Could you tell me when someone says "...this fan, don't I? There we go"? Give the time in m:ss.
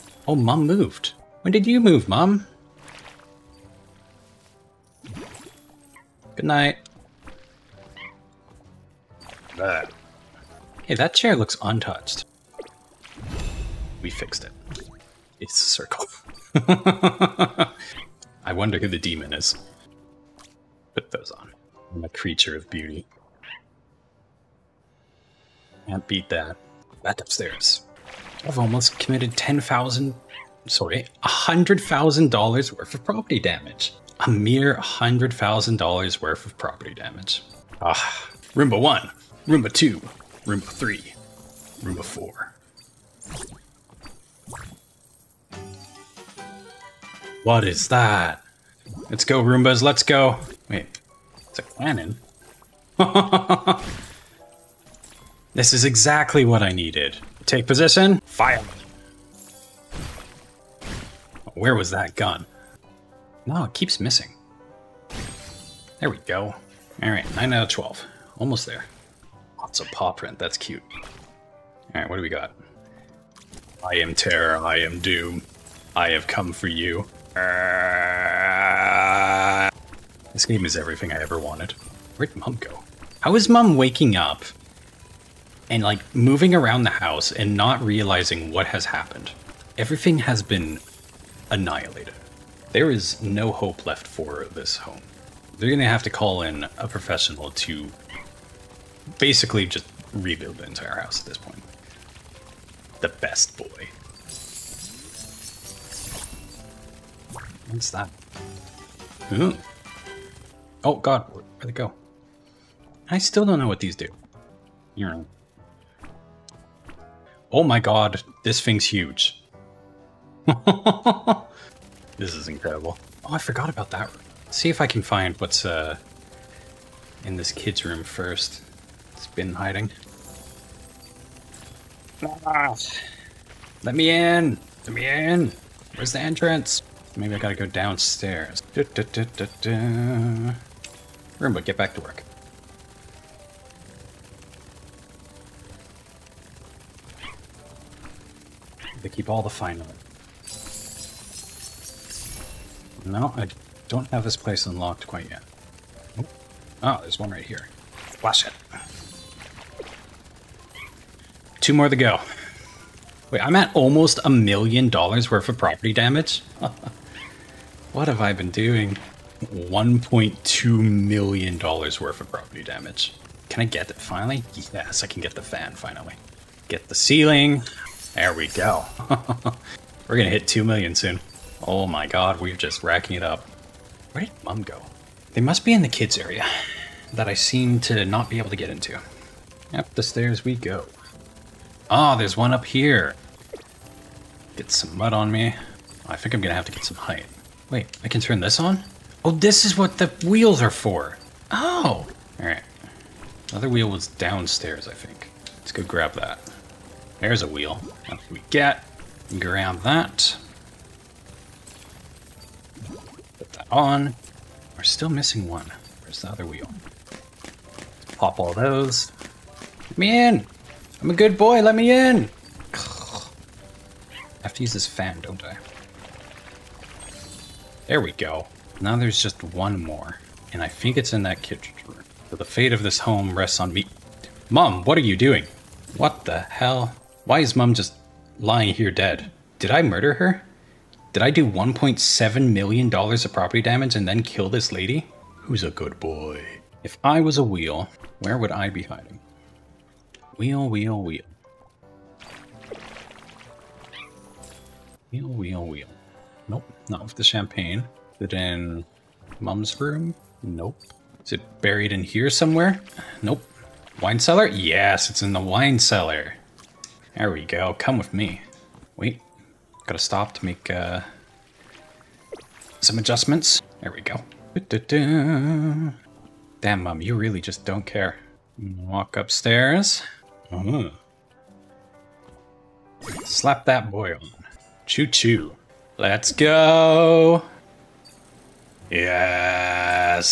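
3:44.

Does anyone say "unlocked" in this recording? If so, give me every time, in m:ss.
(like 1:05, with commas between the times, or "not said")
2:34.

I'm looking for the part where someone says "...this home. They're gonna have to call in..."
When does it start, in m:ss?
1:34.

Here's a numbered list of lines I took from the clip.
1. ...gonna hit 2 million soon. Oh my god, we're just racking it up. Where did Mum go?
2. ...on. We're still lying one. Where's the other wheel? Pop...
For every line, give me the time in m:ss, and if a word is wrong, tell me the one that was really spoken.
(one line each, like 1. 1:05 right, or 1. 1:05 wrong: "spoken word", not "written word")
1. 3:00 right
2. 3:33 wrong: "missing", not "lying".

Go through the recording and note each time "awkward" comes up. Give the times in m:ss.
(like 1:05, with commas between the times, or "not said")
not said.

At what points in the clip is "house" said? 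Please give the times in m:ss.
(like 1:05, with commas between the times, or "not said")
1:26, 1:40.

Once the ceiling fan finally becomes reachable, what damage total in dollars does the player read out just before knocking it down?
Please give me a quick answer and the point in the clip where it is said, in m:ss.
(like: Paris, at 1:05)
$1.2 million, at 2:49.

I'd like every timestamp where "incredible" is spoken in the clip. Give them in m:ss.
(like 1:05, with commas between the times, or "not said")
2:02.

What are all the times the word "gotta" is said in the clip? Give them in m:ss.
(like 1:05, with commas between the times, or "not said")
2:17, 4:29.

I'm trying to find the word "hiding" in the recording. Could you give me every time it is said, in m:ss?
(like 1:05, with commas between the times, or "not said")
2:09, 4:08.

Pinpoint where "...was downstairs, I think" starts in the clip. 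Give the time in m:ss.
3:23.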